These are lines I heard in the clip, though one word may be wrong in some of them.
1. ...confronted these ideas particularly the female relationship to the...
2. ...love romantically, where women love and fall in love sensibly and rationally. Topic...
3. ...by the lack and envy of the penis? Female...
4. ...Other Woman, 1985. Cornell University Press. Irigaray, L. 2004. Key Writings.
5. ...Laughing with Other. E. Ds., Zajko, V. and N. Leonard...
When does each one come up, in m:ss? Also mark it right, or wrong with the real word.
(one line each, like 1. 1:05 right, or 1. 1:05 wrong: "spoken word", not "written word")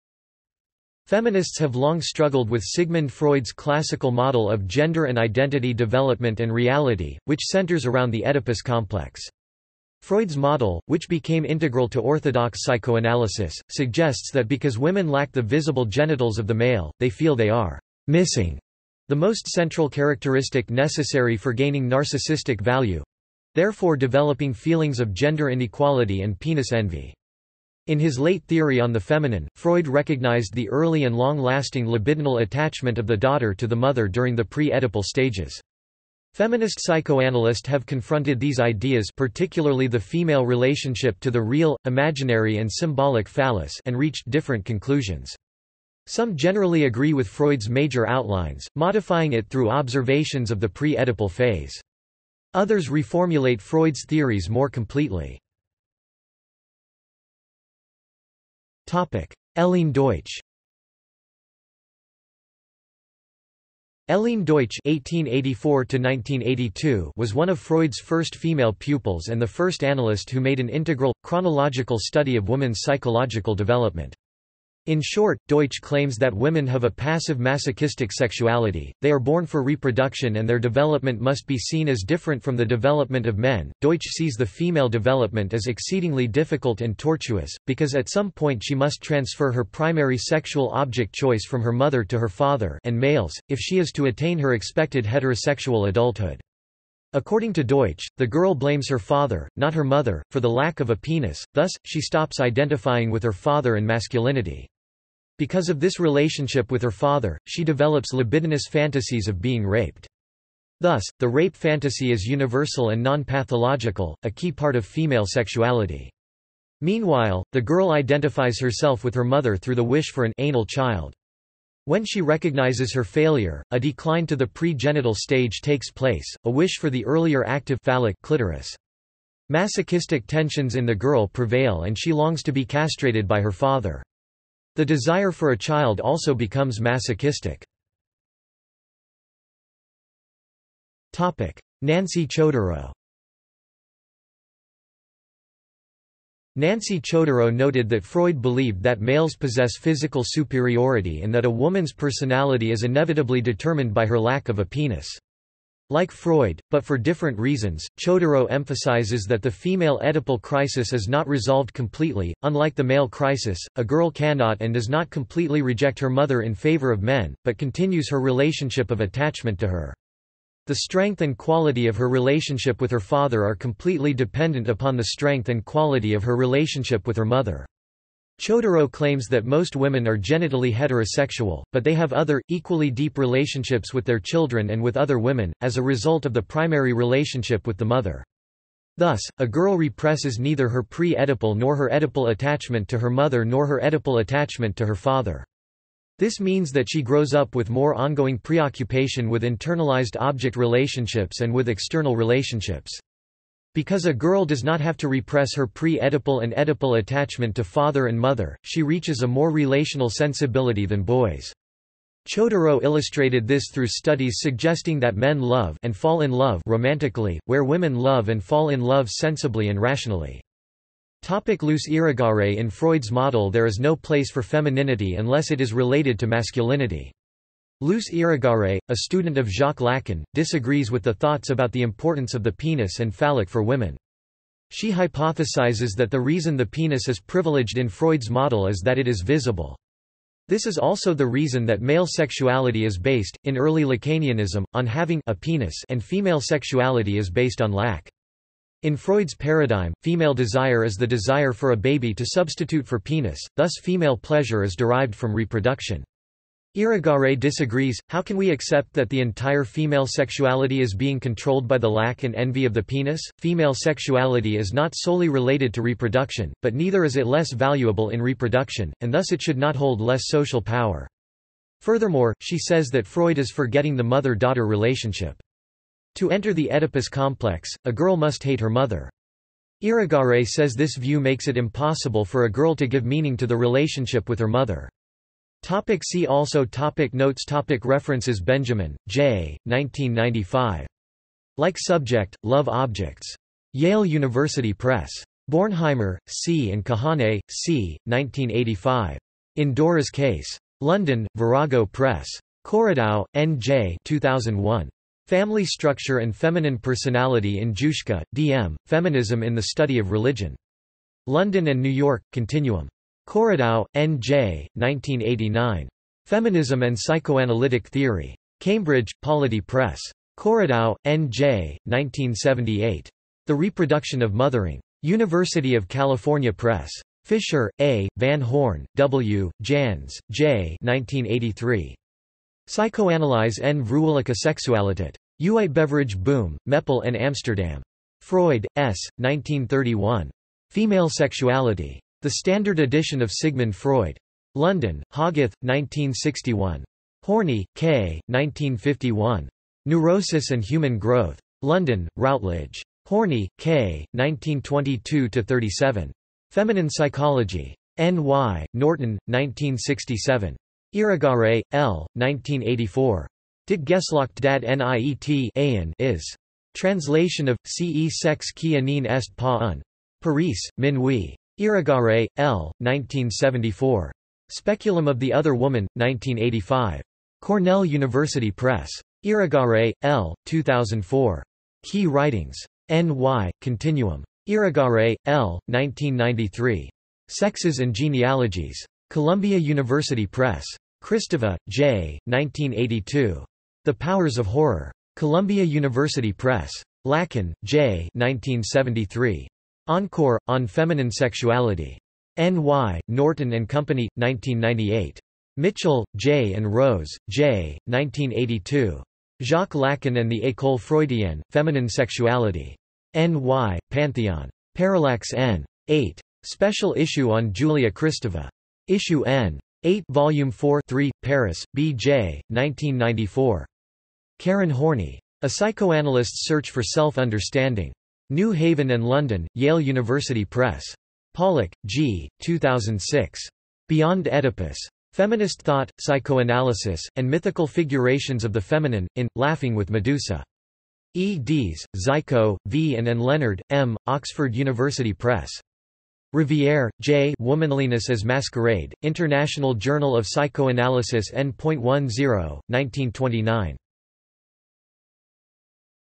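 1. 0:37 right
2. 3:36 right
3. 4:21 right
4. 6:15 right
5. 7:19 wrong: "Medusa", not "Other".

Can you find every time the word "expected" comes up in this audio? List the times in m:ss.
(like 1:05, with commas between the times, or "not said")
1:34.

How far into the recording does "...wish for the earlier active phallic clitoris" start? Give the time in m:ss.
2:06.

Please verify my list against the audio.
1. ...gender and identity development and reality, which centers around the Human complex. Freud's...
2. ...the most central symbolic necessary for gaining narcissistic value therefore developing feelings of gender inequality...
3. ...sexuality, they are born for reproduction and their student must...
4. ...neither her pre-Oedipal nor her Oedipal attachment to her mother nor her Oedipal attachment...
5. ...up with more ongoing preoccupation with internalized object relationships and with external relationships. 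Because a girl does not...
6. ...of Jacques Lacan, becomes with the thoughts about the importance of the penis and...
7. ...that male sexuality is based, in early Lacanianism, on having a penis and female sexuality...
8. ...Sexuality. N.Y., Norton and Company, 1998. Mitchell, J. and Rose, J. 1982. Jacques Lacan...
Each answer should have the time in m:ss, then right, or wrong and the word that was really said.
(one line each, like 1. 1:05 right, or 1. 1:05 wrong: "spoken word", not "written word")
1. 0:04 wrong: "Oedipus", not "Human"
2. 0:19 wrong: "characteristic", not "symbolic"
3. 1:18 wrong: "development", not "student"
4. 3:10 right
5. 3:17 right
6. 3:49 wrong: "disagrees", not "becomes"
7. 4:01 right
8. 6:41 right.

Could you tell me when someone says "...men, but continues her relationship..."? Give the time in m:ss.
2:47.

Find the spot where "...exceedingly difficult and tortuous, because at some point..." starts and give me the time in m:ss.
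1:25.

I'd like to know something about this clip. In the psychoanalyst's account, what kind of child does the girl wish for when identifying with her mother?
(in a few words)
an anal child.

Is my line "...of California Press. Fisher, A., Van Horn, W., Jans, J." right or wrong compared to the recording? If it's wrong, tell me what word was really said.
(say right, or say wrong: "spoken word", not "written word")
right.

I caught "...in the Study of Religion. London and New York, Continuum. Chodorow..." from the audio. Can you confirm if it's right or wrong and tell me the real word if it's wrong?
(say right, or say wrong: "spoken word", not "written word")
right.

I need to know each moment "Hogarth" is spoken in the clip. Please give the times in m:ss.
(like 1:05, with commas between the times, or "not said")
5:45.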